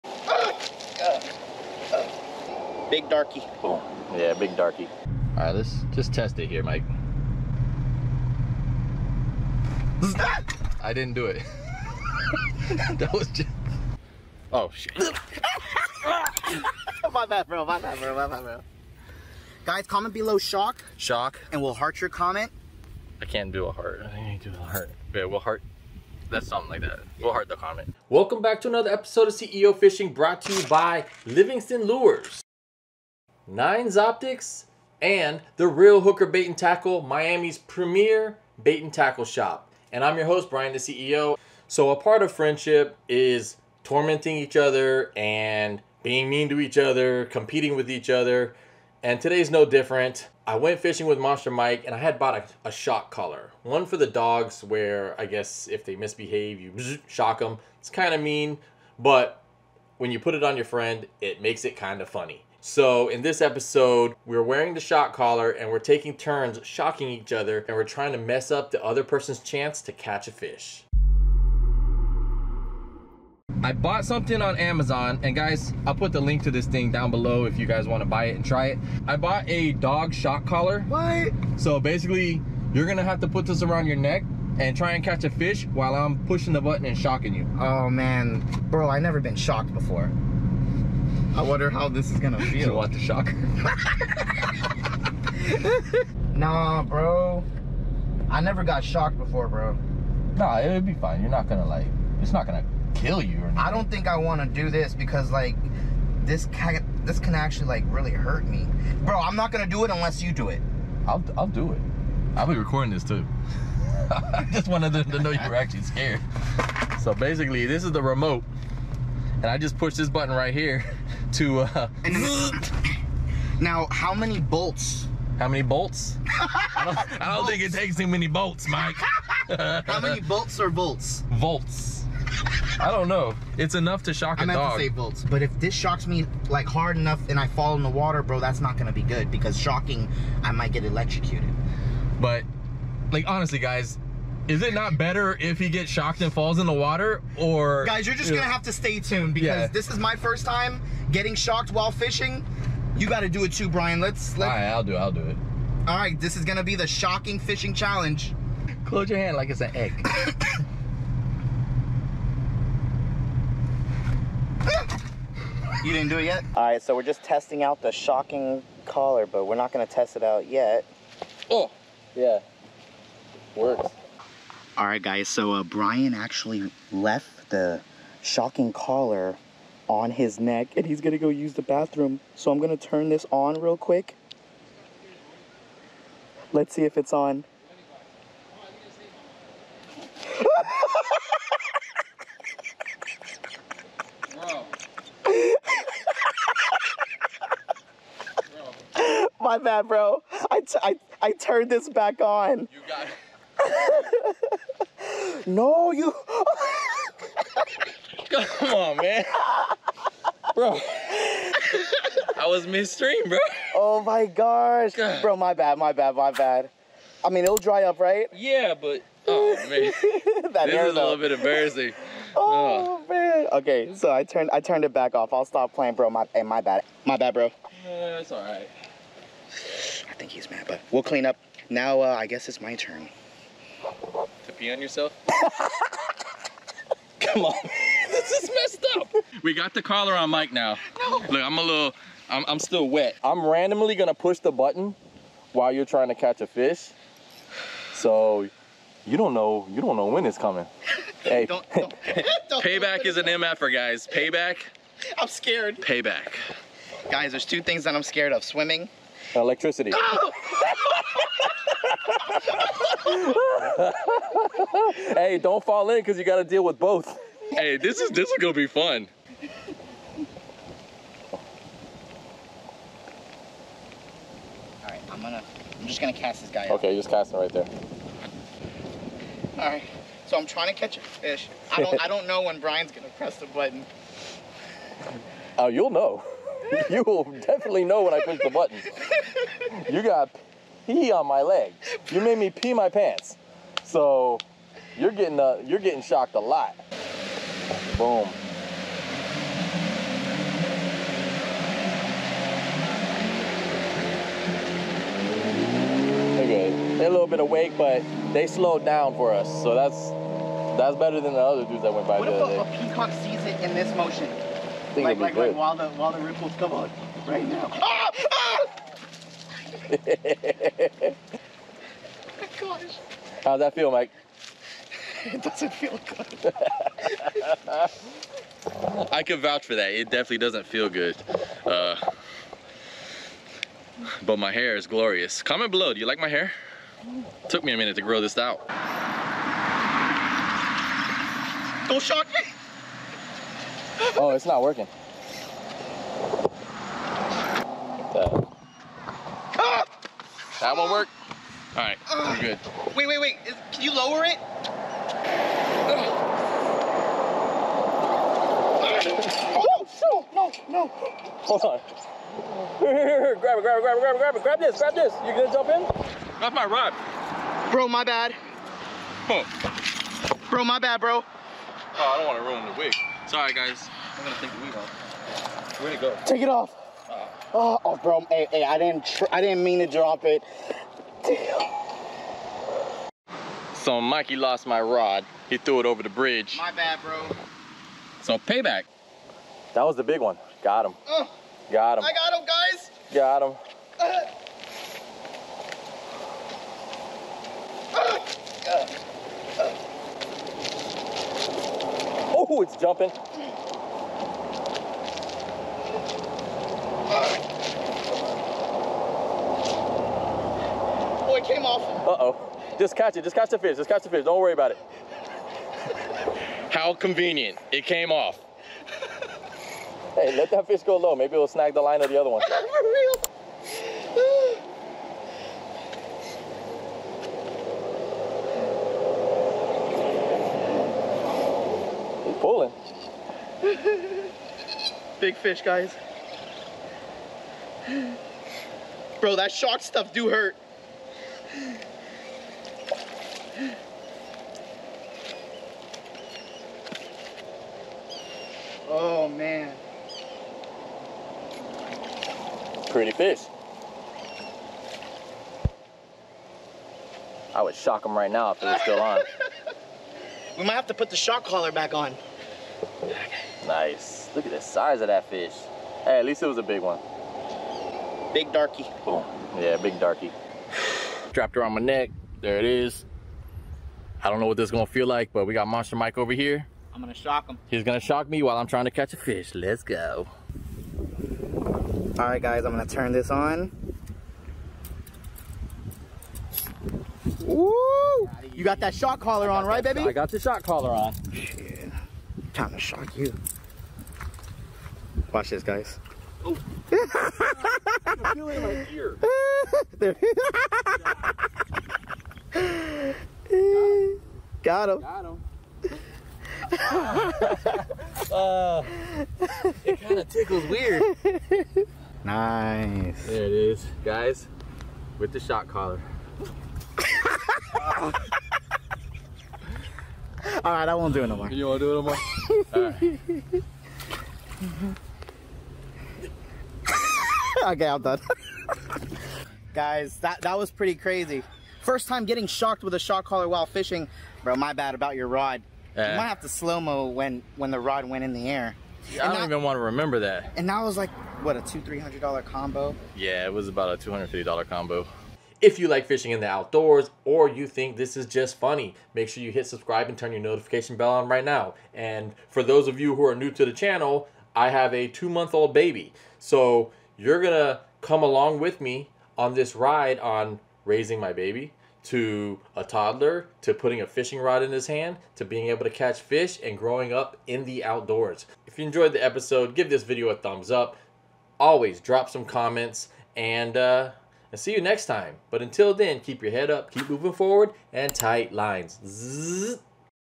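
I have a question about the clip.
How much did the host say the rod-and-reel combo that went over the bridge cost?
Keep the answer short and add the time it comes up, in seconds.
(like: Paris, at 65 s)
$250, at 543 s.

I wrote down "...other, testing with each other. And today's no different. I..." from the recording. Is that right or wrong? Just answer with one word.
wrong.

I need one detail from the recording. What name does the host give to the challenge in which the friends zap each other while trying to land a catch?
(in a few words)
shocking fishing challenge.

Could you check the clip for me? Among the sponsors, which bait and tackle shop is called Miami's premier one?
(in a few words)
Reel Hooker Bait and Tackle.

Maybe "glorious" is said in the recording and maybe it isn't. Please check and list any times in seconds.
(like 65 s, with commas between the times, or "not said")
334 s.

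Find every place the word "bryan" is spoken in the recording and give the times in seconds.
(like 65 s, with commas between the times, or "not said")
40 s, 153 s, 175 s, 282 s.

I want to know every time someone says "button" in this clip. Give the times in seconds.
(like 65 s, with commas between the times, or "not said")
86 s, 120 s, 244 s, 283 s, 288 s.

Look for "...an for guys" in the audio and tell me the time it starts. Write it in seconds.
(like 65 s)
253 s.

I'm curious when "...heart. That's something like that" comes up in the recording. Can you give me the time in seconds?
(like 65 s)
25 s.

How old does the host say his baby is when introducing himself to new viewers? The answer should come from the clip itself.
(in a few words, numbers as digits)
2 months.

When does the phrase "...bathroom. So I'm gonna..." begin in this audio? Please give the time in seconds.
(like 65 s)
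181 s.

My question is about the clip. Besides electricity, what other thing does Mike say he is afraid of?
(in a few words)
swimming.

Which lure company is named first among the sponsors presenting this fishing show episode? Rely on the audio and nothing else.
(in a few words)
Livingston Lures.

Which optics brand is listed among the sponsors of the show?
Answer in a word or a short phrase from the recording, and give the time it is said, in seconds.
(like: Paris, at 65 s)
Nines Optics, at 33 s.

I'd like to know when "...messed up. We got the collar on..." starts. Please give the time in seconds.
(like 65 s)
238 s.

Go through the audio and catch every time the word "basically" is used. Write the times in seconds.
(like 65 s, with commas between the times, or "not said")
81 s, 117 s.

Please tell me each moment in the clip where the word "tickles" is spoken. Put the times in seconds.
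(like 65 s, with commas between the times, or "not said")
510 s.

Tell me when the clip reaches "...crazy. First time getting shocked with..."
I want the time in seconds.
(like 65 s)
530 s.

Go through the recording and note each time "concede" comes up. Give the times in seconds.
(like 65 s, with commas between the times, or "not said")
not said.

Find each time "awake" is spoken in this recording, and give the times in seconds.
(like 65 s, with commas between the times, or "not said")
307 s.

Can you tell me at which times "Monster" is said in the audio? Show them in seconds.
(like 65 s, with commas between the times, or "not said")
51 s, 475 s.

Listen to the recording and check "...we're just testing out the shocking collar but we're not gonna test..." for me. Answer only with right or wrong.
right.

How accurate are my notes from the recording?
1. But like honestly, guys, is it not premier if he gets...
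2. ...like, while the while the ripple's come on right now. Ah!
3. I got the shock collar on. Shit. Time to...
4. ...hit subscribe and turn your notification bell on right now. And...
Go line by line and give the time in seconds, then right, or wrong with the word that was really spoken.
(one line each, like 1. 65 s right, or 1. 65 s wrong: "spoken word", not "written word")
1. 142 s wrong: "better", not "premier"
2. 315 s right
3. 490 s right
4. 549 s right.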